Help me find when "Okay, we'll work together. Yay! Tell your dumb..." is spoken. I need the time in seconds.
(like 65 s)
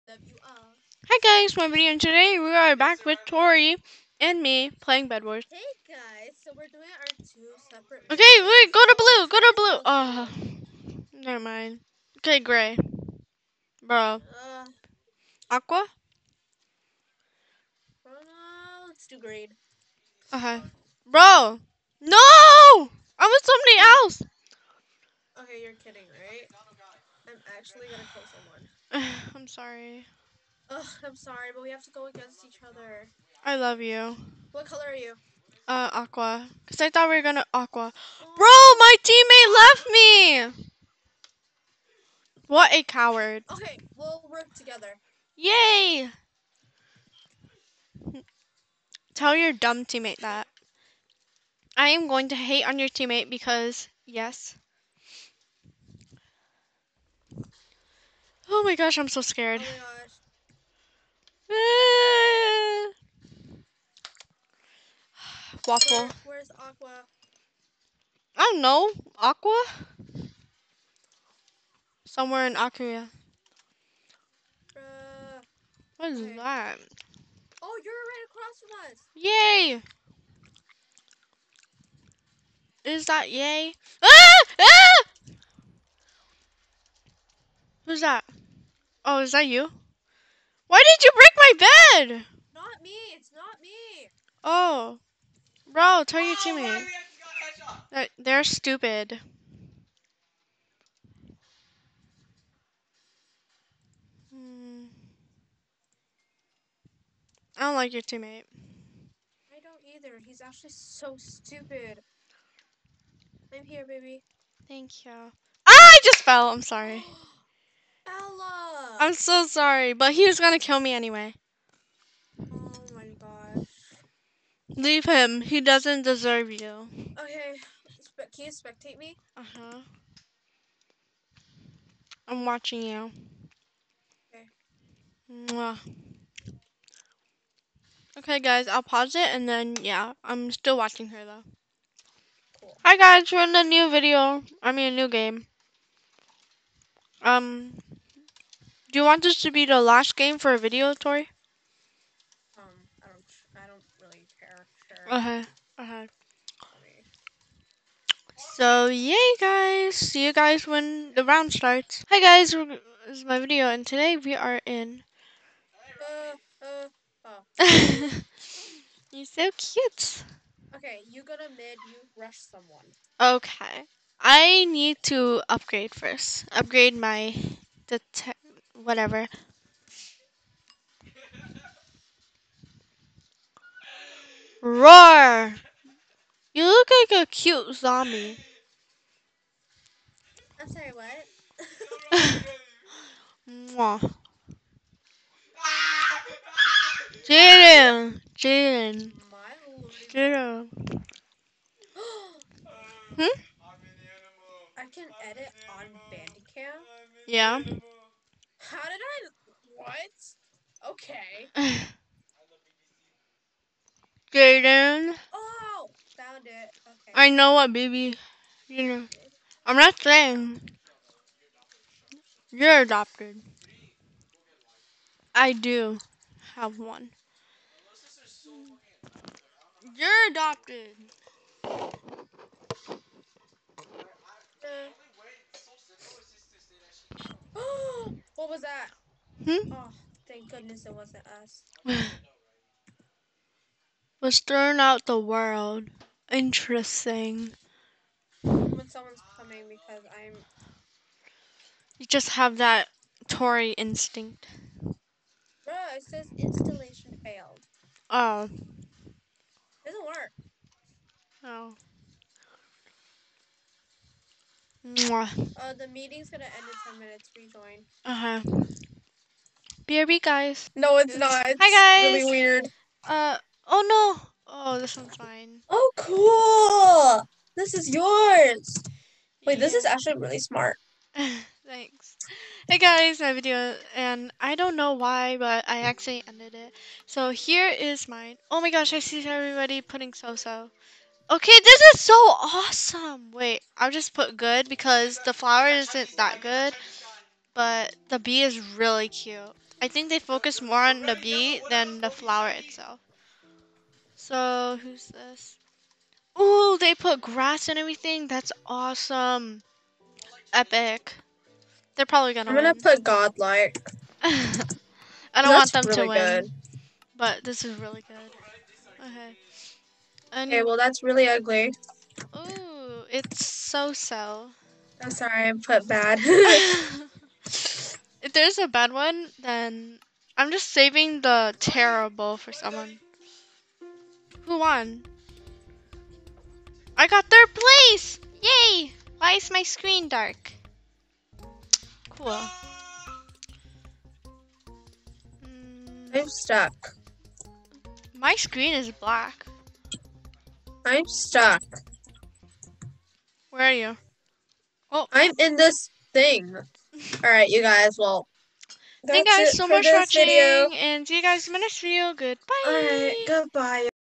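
43 s.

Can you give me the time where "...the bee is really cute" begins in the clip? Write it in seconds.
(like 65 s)
298 s.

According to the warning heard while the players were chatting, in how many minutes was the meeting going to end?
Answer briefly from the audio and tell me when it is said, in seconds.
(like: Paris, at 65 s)
10, at 266 s.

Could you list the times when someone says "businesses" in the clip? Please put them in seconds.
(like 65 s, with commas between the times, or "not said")
not said.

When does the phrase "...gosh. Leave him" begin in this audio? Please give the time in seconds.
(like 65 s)
123 s.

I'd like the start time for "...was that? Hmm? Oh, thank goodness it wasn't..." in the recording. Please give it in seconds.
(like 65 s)
238 s.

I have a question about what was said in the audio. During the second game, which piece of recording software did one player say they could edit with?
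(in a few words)
Bandicam.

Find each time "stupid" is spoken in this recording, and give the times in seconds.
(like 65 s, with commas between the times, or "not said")
98 s, 111 s.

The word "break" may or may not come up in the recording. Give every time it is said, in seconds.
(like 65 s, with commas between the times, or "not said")
91 s.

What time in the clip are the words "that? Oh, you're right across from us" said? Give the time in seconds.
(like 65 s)
76 s.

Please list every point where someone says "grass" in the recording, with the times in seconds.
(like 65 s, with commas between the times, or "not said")
307 s.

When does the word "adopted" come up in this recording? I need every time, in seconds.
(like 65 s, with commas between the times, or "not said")
222 s, 230 s.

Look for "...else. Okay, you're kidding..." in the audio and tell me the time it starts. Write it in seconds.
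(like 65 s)
23 s.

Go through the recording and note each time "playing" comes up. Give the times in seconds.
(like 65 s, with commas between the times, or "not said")
4 s.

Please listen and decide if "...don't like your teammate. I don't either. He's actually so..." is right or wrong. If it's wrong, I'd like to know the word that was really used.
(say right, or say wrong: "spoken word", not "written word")
right.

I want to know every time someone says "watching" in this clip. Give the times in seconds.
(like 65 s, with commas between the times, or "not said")
132 s, 140 s, 359 s.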